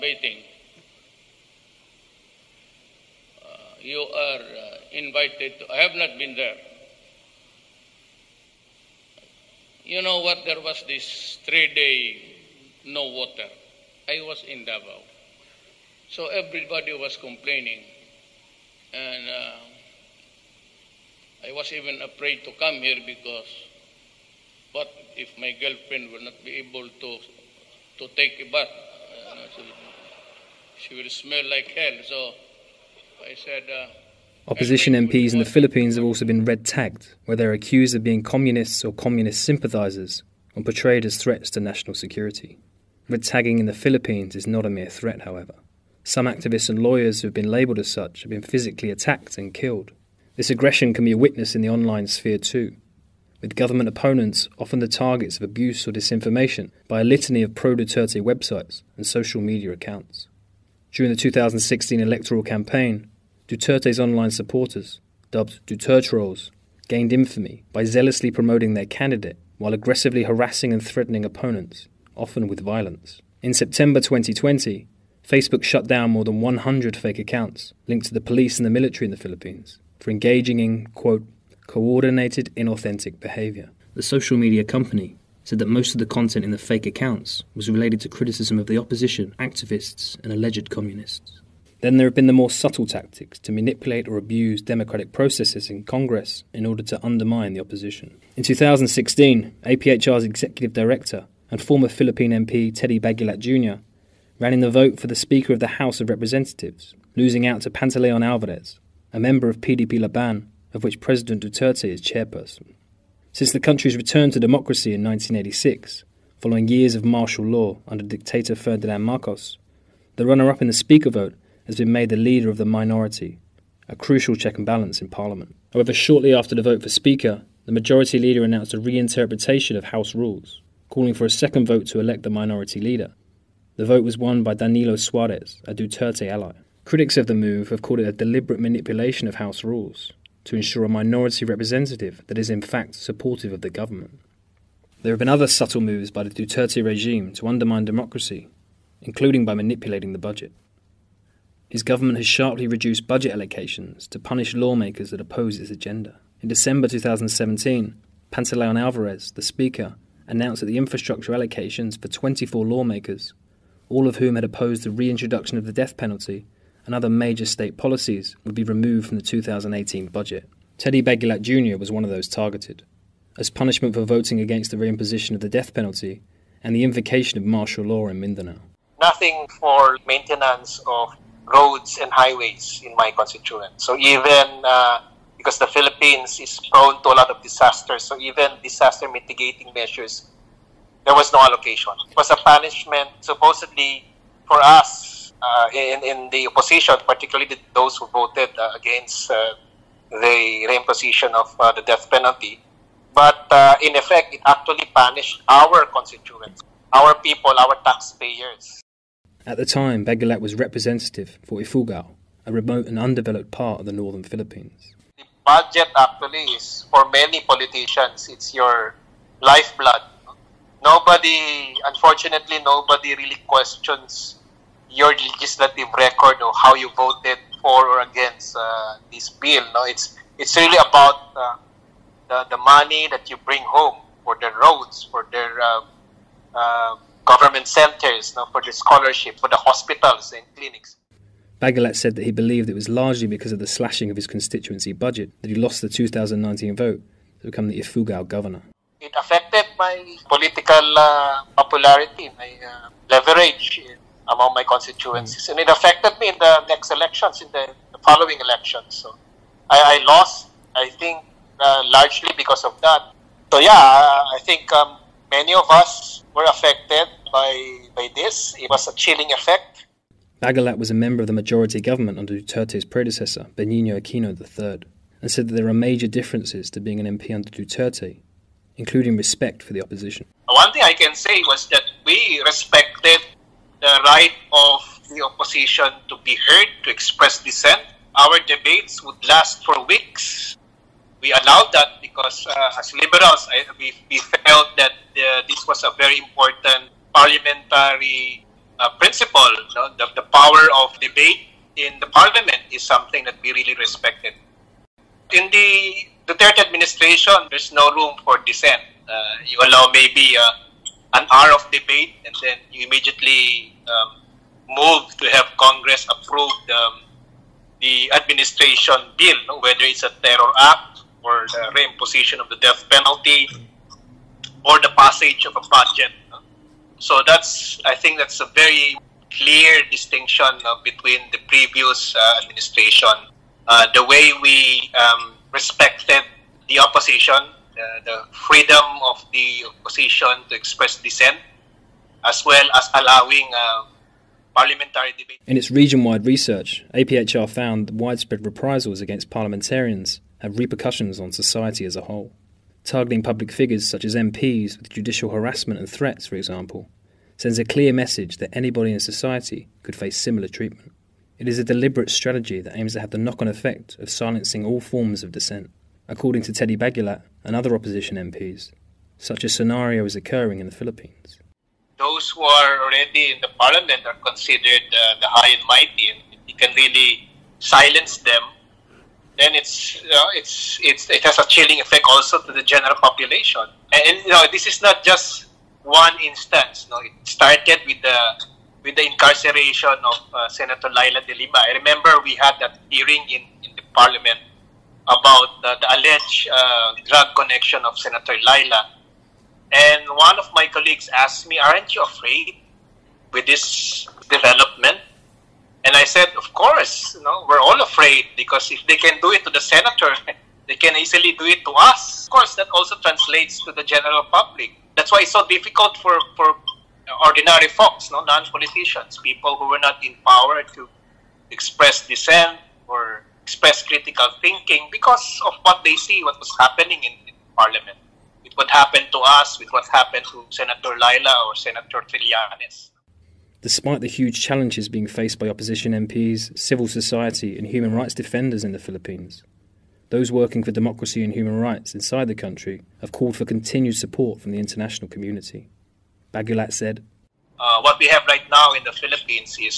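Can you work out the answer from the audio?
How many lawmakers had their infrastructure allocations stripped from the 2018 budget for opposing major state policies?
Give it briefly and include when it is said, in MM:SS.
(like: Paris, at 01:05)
24, at 02:42.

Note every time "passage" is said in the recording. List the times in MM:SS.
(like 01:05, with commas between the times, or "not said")
05:24.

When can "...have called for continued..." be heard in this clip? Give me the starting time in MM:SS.
07:23.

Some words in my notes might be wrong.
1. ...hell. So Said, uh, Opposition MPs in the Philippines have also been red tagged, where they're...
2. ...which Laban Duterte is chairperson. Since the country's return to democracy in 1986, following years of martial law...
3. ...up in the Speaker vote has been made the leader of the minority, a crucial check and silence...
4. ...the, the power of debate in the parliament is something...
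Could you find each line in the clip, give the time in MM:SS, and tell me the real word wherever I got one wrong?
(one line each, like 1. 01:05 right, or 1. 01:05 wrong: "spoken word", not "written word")
1. 00:31 right
2. 01:50 wrong: "President", not "Laban"
3. 02:00 wrong: "balance", not "silence"
4. 04:59 right.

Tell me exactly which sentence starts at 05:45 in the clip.
In its region wide research, APHR found that widespread reprisals against parliamentarians have repercussions on society as a whole.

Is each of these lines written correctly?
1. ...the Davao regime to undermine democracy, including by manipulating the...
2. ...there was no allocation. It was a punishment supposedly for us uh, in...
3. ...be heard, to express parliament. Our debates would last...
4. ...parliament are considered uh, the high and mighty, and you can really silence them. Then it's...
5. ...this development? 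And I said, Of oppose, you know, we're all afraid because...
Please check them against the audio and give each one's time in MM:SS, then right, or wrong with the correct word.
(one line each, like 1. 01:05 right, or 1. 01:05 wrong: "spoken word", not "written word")
1. 02:26 wrong: "Duterte", not "Davao"
2. 03:11 right
3. 04:46 wrong: "dissent", not "parliament"
4. 06:13 right
5. 06:43 wrong: "course", not "oppose".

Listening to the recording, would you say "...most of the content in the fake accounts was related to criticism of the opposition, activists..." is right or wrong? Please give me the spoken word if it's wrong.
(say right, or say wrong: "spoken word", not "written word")
right.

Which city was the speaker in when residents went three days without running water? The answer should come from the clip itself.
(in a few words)
Davao.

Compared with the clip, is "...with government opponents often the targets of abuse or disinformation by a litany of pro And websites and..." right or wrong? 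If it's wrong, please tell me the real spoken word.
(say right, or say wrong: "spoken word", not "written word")
wrong: "Duterte", not "And".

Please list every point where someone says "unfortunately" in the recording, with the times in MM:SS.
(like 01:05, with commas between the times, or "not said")
03:41.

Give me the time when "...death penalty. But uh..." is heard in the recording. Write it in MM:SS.
03:21.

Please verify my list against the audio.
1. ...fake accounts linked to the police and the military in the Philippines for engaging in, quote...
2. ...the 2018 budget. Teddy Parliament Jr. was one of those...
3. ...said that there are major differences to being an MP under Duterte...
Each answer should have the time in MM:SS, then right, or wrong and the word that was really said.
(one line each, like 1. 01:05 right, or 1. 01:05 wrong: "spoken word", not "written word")
1. 01:16 right
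2. 02:49 wrong: "Baguilat", not "Parliament"
3. 04:35 right.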